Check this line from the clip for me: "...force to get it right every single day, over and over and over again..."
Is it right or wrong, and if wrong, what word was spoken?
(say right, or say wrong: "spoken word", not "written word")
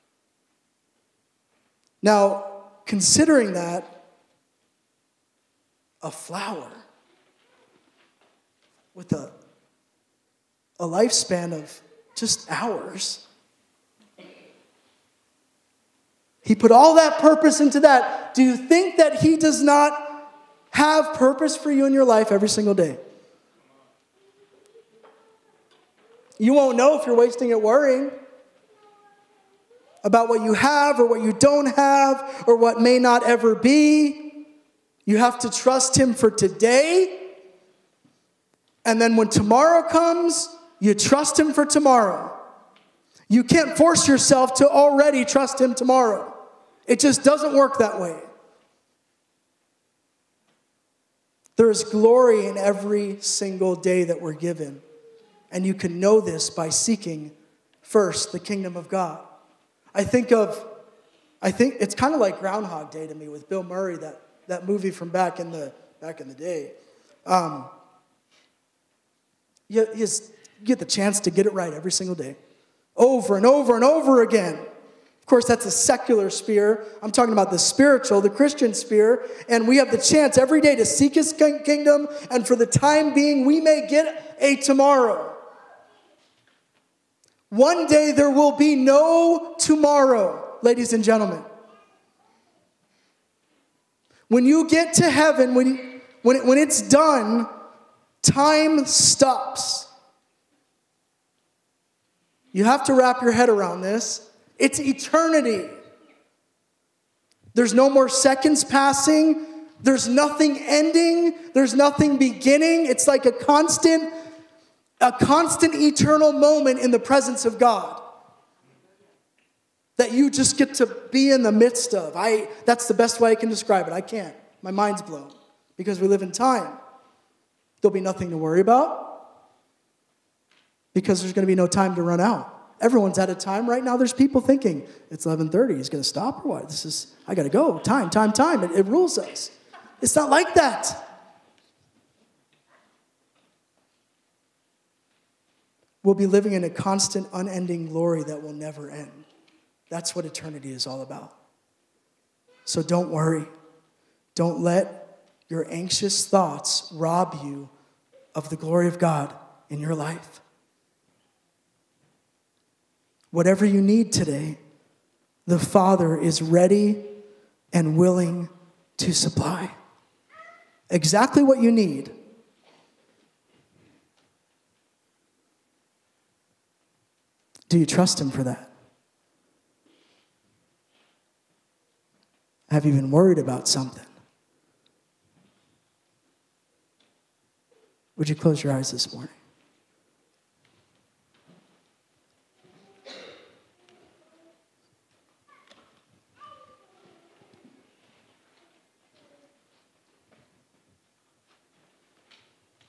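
wrong: "chance", not "force".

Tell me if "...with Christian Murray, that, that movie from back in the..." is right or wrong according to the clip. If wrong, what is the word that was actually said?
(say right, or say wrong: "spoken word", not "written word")
wrong: "Bill", not "Christian".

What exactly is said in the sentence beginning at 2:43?
Whatever you need today, the Father is ready and willing to supply exactly what you need.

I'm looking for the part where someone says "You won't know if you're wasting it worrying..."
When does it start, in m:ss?
0:26.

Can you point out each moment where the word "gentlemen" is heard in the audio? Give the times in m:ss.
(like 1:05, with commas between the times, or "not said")
1:31.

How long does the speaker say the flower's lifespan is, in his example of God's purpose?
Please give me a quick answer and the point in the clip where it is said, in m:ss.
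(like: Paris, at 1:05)
just hours, at 0:12.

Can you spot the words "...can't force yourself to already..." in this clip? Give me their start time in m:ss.
0:43.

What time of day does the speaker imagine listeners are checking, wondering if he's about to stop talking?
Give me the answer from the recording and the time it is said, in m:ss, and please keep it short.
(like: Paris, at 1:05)
11:30, at 2:15.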